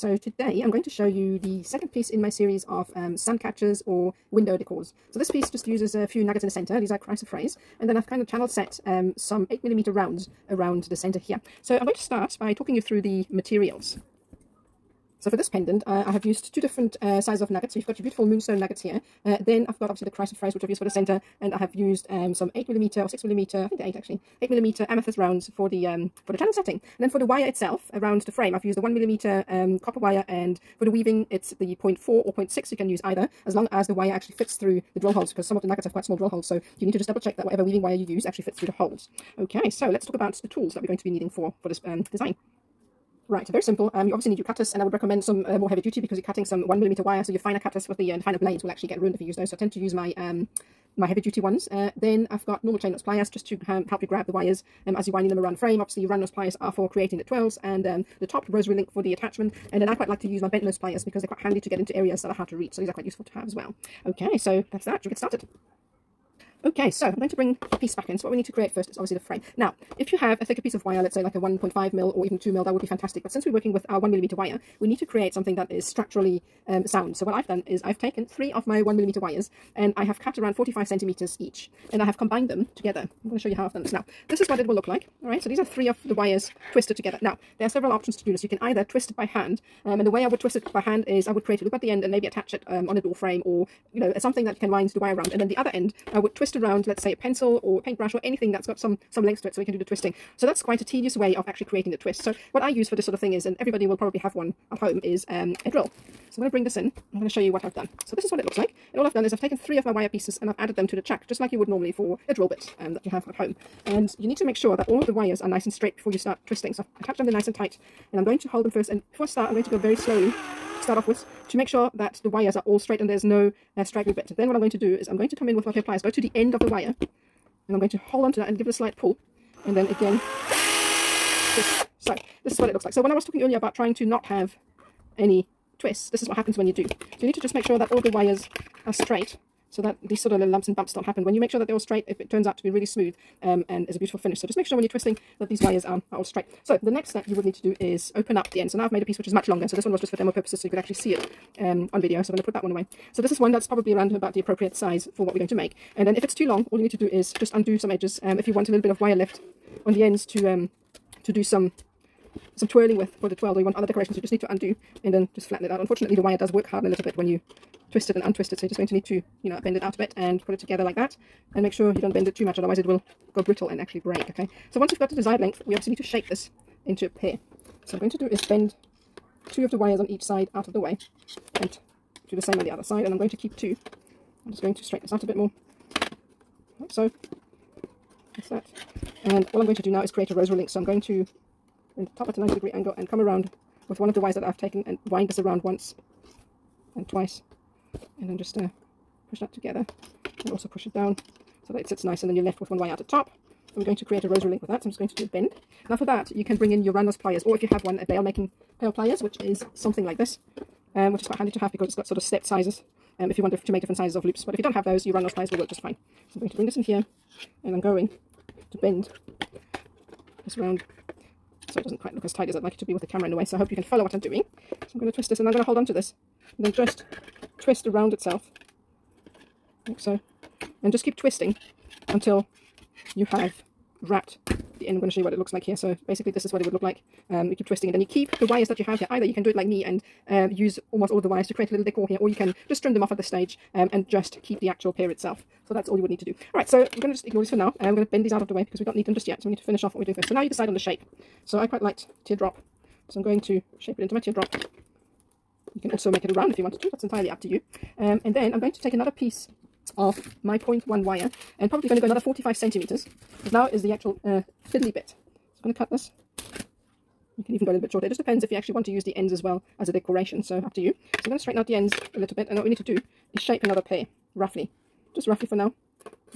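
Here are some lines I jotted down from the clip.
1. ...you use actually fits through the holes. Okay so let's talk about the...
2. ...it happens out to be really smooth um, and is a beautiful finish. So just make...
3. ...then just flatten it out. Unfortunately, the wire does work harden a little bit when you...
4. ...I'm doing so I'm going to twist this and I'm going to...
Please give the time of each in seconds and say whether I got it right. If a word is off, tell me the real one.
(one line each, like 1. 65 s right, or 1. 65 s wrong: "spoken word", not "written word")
1. 37 s right
2. 142 s wrong: "turns", not "happens"
3. 165 s right
4. 224 s right.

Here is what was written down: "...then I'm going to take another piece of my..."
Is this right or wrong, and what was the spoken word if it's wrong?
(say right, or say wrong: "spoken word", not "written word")
right.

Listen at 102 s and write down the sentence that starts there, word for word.
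So what I use for this sort of thing is, and everybody will probably have one at home, is um, a drill.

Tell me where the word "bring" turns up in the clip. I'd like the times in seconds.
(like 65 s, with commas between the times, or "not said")
67 s, 106 s, 206 s, 216 s.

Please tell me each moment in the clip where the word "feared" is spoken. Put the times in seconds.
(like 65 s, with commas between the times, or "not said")
not said.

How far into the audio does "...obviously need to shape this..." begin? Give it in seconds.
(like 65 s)
175 s.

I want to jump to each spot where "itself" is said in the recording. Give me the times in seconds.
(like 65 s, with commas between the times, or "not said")
27 s, 228 s, 245 s.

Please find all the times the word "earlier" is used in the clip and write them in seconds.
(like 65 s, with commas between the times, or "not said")
133 s.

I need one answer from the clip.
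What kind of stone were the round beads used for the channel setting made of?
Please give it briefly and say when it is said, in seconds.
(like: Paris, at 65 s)
Amethyst, at 24 s.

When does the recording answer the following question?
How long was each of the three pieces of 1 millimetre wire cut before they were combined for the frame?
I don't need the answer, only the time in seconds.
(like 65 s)
80 s.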